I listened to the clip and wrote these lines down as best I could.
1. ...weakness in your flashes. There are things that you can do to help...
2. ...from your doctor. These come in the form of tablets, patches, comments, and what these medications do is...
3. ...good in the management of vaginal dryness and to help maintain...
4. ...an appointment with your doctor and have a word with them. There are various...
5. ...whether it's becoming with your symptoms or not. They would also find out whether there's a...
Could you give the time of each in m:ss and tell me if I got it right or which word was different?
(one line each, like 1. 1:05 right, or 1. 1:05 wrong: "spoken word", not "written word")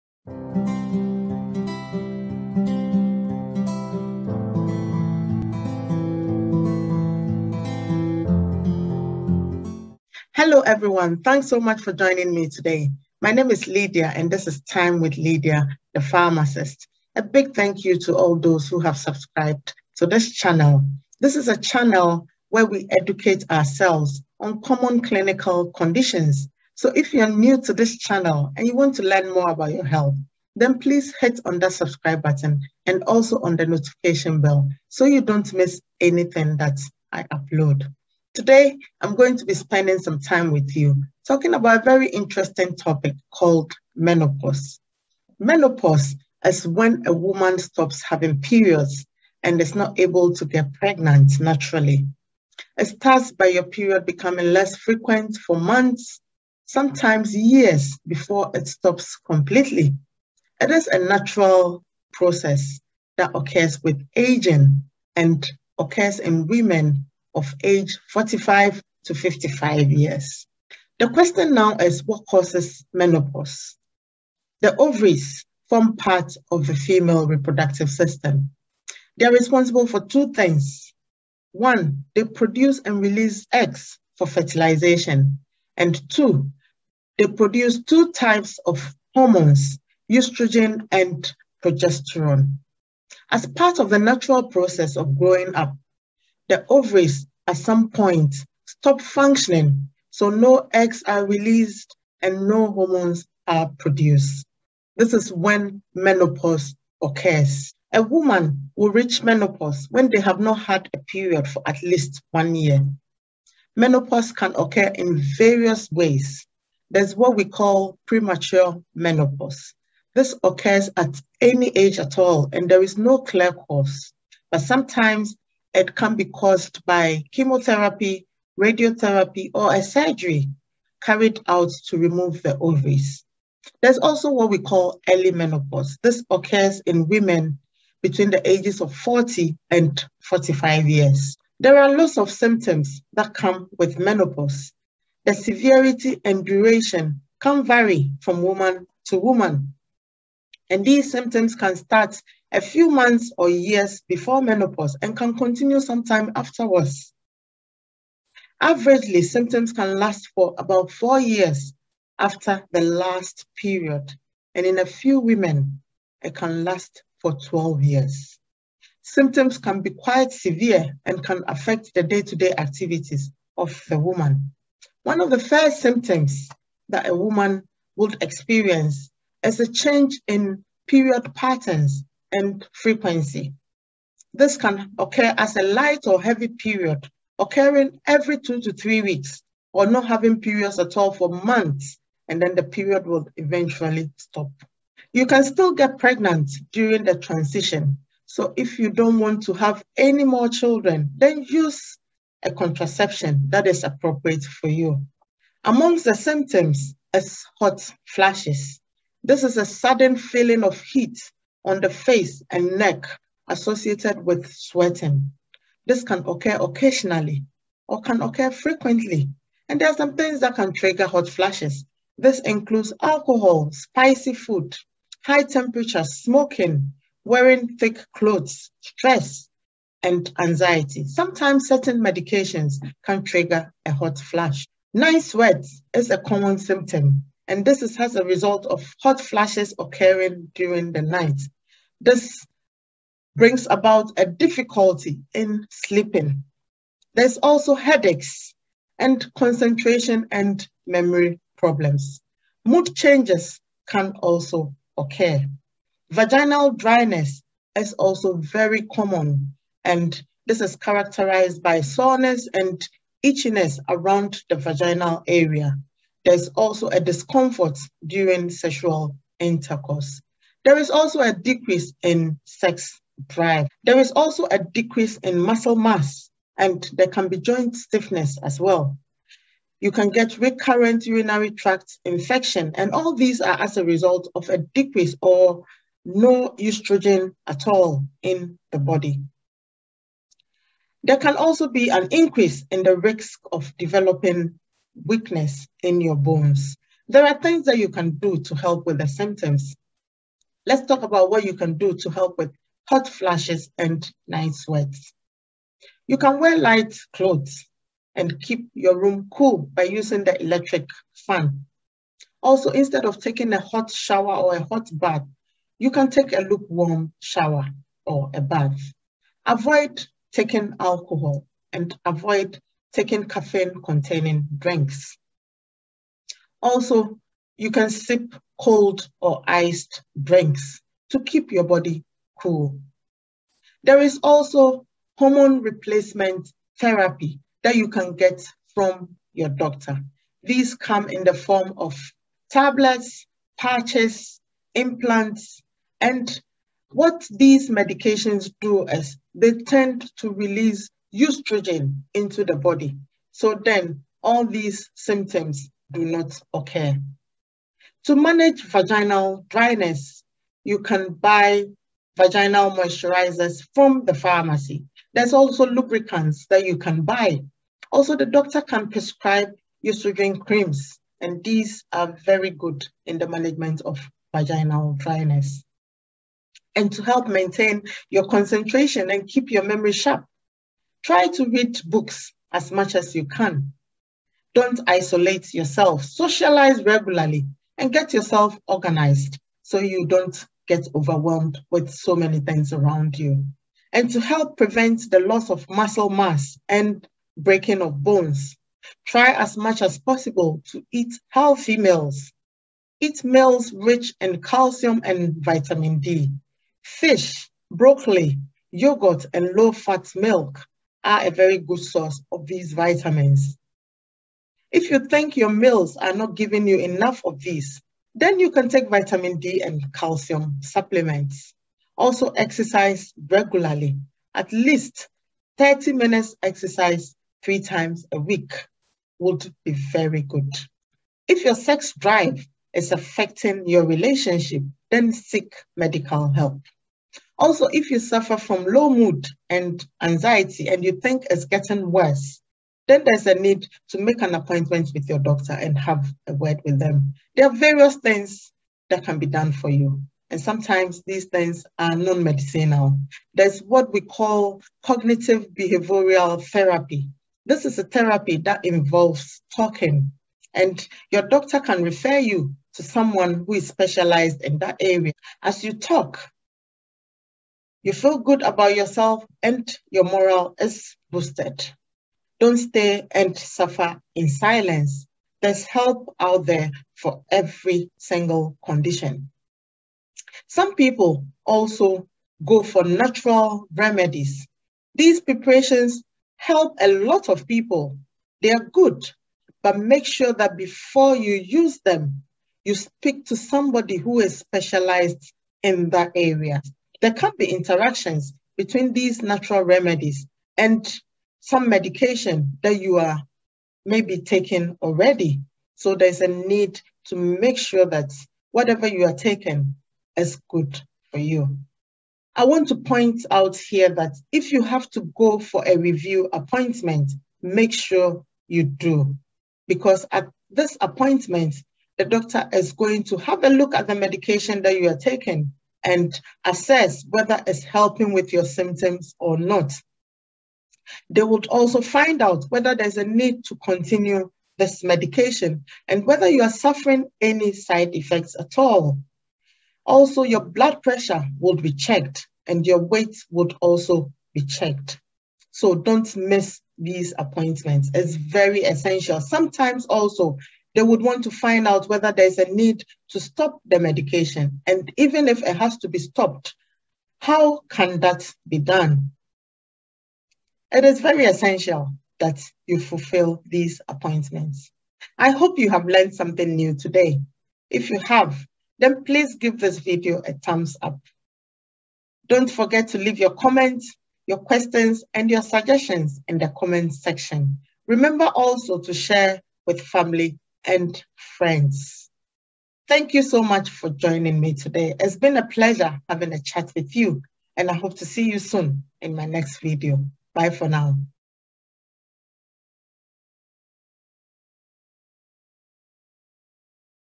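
1. 4:55 wrong: "bones", not "flashes"
2. 5:38 wrong: "implants", not "comments"
3. 6:12 right
4. 7:24 right
5. 8:47 wrong: "helping", not "becoming".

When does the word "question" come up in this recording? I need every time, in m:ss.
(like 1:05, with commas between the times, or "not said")
1:11, 9:34.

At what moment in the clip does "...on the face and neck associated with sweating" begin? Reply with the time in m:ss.
3:31.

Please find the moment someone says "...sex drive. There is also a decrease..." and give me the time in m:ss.
4:32.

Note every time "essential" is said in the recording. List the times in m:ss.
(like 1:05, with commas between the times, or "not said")
9:08, 9:21.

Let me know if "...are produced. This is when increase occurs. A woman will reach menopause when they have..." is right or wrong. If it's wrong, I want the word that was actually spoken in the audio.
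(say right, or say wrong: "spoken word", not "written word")
wrong: "menopause", not "increase".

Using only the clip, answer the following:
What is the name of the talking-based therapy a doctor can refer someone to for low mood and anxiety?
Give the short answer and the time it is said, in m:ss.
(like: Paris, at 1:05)
cognitive behavioral therapy, at 7:34.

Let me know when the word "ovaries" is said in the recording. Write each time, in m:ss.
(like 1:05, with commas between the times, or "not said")
1:14, 1:36, 2:12.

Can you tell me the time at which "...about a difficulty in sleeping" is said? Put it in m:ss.
4:03.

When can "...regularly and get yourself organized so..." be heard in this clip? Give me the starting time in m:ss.
6:26.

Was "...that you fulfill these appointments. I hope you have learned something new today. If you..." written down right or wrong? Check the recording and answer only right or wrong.
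right.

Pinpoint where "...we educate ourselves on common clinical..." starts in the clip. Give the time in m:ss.
0:22.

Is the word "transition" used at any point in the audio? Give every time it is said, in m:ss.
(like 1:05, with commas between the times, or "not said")
3:17.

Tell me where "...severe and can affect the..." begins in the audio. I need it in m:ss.
2:50.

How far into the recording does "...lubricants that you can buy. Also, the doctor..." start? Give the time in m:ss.
6:05.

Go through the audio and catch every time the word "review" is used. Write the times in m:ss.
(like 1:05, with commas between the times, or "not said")
8:35.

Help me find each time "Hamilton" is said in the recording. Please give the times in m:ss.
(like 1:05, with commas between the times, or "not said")
not said.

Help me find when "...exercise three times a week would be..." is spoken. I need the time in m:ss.
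7:06.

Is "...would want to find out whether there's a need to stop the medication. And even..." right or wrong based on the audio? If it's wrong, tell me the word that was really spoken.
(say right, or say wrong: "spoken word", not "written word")
right.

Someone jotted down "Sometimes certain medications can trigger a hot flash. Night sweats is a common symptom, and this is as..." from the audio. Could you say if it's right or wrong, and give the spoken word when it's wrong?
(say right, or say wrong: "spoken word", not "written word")
right.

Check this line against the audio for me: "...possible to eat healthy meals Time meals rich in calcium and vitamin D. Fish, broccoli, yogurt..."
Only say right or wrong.
wrong.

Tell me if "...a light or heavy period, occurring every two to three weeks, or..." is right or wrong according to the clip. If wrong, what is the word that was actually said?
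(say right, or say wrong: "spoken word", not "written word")
right.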